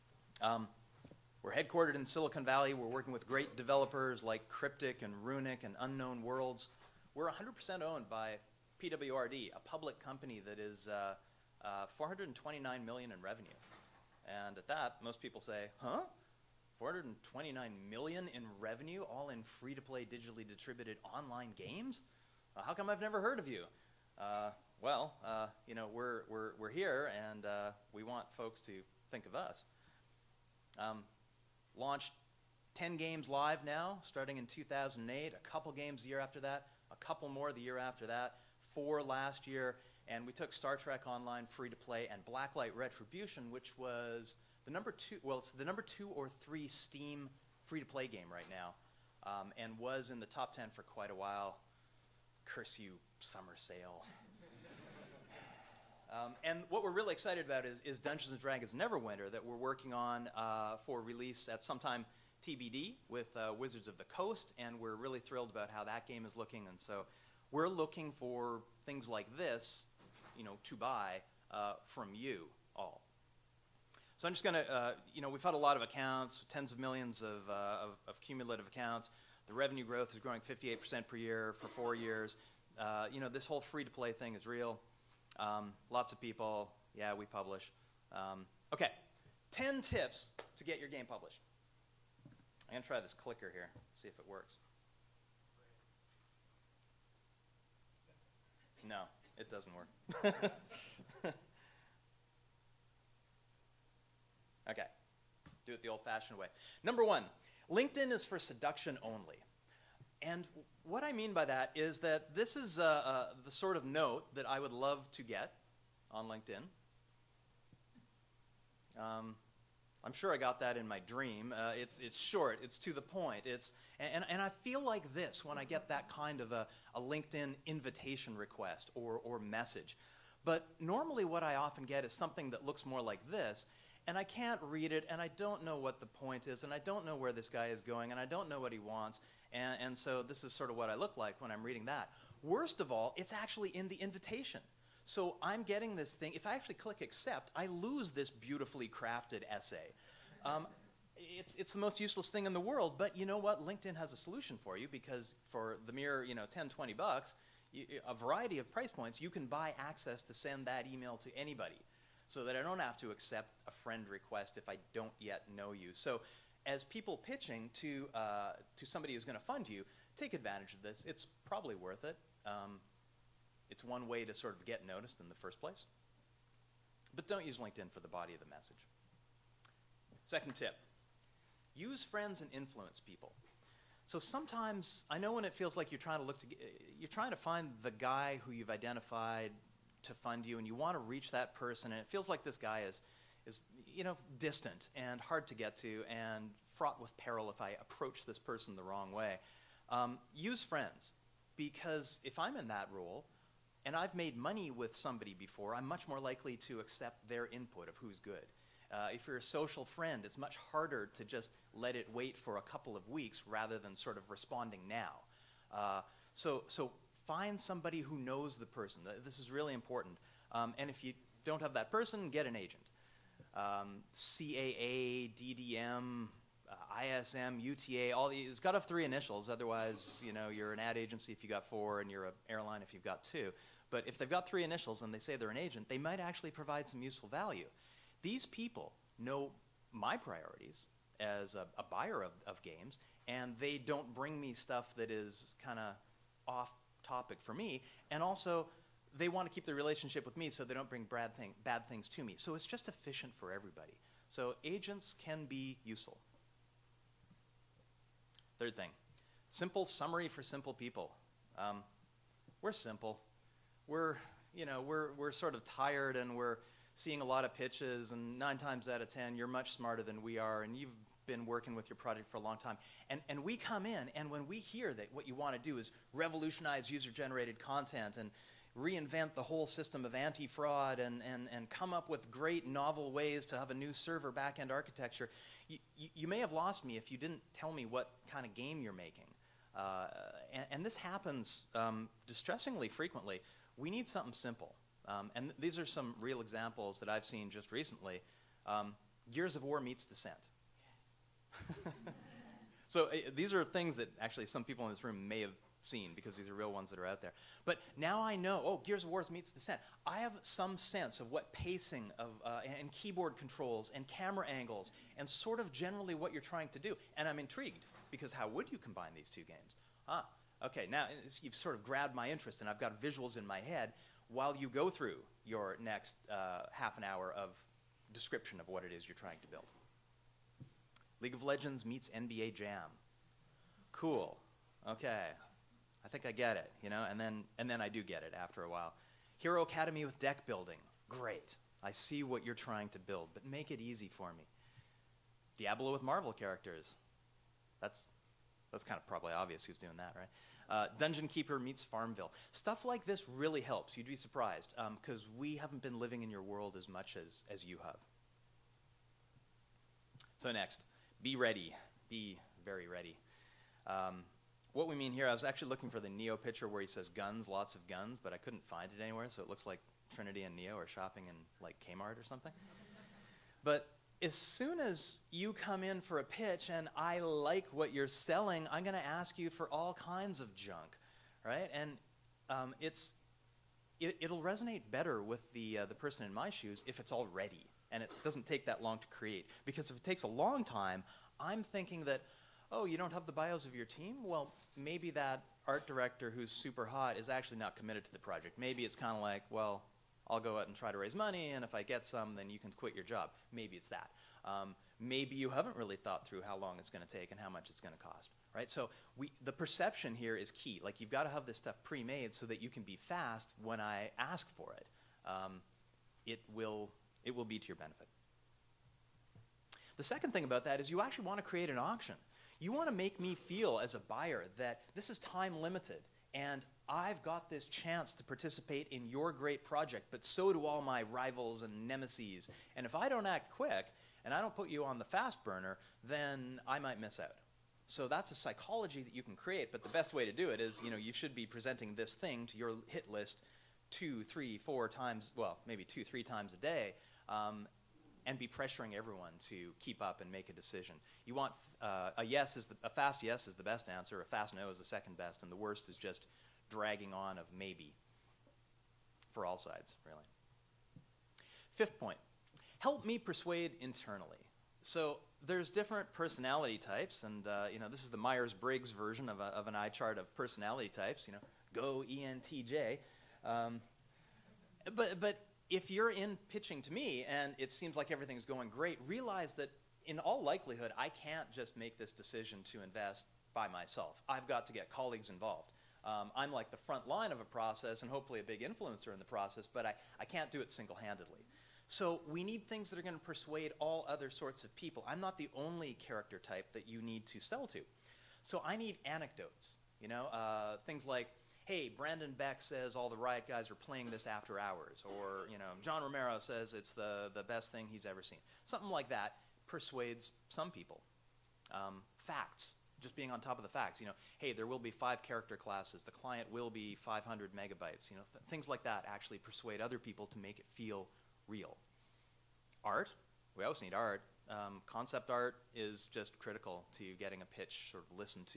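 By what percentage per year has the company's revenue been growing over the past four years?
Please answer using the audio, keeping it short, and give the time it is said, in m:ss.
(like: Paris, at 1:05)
58%, at 1:20.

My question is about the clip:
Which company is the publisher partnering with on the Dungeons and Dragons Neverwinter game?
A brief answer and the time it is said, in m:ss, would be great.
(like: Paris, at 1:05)
Wizards of the Coast, at 1:03.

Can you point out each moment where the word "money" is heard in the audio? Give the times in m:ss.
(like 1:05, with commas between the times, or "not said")
3:24, 6:41.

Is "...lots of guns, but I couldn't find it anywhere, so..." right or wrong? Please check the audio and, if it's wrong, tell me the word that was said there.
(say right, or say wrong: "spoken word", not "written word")
right.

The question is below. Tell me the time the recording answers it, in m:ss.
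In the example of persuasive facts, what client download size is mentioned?
8:36.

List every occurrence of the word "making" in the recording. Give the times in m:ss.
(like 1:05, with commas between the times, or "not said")
4:48.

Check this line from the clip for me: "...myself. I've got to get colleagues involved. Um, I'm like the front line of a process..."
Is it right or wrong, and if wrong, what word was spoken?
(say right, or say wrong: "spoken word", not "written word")
right.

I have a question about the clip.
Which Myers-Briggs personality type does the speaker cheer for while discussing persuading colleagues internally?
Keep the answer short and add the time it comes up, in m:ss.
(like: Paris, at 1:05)
ENTJ, at 7:52.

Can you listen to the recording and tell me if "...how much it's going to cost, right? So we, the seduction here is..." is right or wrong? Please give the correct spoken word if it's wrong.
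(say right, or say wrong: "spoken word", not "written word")
wrong: "perception", not "seduction".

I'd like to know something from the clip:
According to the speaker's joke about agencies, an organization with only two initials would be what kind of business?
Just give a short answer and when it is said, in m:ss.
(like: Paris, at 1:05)
An airline, at 3:52.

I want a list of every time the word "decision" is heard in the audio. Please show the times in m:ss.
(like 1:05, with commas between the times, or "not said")
7:30, 8:02.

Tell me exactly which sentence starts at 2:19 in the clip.
And, and so, this is sort of what I look like when I'm reading that.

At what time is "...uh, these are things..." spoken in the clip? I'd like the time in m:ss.
5:03.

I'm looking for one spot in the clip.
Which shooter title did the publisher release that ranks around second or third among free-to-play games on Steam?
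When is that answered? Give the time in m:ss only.
0:42.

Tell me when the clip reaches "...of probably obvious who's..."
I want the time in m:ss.
5:48.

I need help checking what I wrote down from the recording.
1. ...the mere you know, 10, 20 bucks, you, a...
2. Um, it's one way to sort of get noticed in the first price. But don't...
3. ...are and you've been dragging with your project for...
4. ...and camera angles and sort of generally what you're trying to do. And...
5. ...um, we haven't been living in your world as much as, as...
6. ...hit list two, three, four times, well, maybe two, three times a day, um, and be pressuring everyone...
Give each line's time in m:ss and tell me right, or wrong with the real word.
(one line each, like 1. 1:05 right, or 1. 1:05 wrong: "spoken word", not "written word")
1. 2:35 right
2. 2:52 wrong: "place", not "price"
3. 4:30 wrong: "working", not "dragging"
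4. 5:13 right
5. 5:55 right
6. 7:22 right.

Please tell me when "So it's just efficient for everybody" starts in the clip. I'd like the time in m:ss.
4:12.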